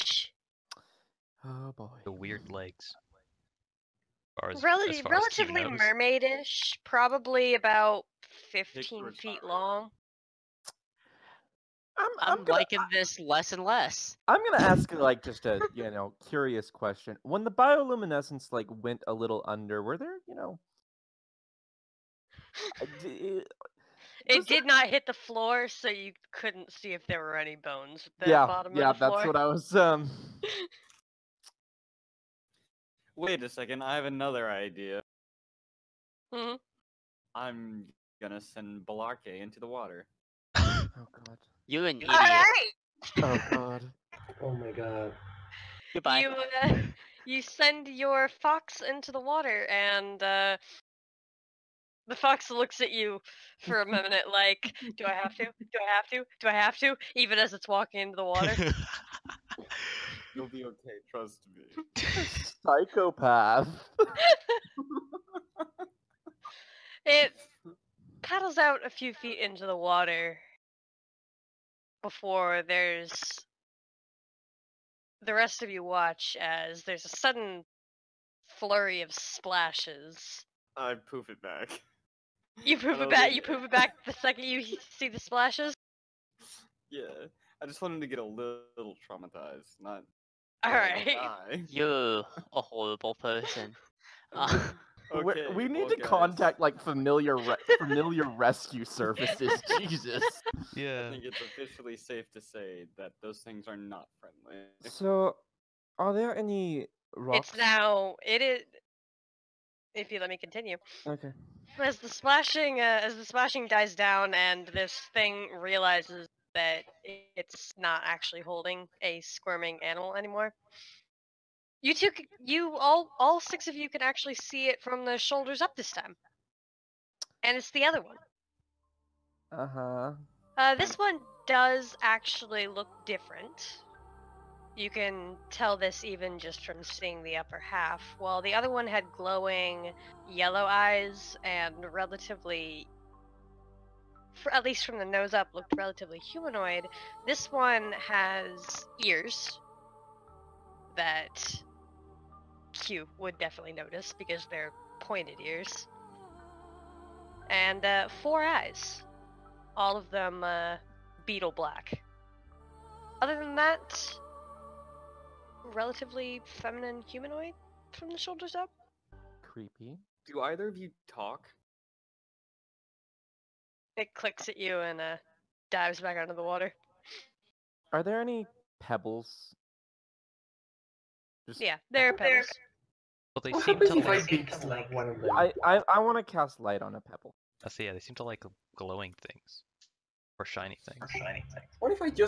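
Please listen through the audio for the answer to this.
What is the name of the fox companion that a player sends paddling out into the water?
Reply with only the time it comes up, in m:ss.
0:38.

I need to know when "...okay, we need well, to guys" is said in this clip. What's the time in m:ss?
1:35.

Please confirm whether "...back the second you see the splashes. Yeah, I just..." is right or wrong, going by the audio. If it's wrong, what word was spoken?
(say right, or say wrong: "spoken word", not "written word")
right.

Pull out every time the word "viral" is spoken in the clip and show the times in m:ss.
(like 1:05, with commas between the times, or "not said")
not said.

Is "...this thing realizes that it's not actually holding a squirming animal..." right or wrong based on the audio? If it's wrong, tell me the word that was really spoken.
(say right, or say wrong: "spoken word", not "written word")
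right.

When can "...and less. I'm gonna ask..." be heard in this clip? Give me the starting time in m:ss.
0:13.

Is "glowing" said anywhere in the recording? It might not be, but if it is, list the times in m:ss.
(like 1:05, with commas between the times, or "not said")
2:19, 3:08.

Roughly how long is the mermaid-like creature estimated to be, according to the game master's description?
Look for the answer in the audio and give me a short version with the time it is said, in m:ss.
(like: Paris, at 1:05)
15 feet, at 0:08.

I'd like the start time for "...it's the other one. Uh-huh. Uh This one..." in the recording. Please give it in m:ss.
2:07.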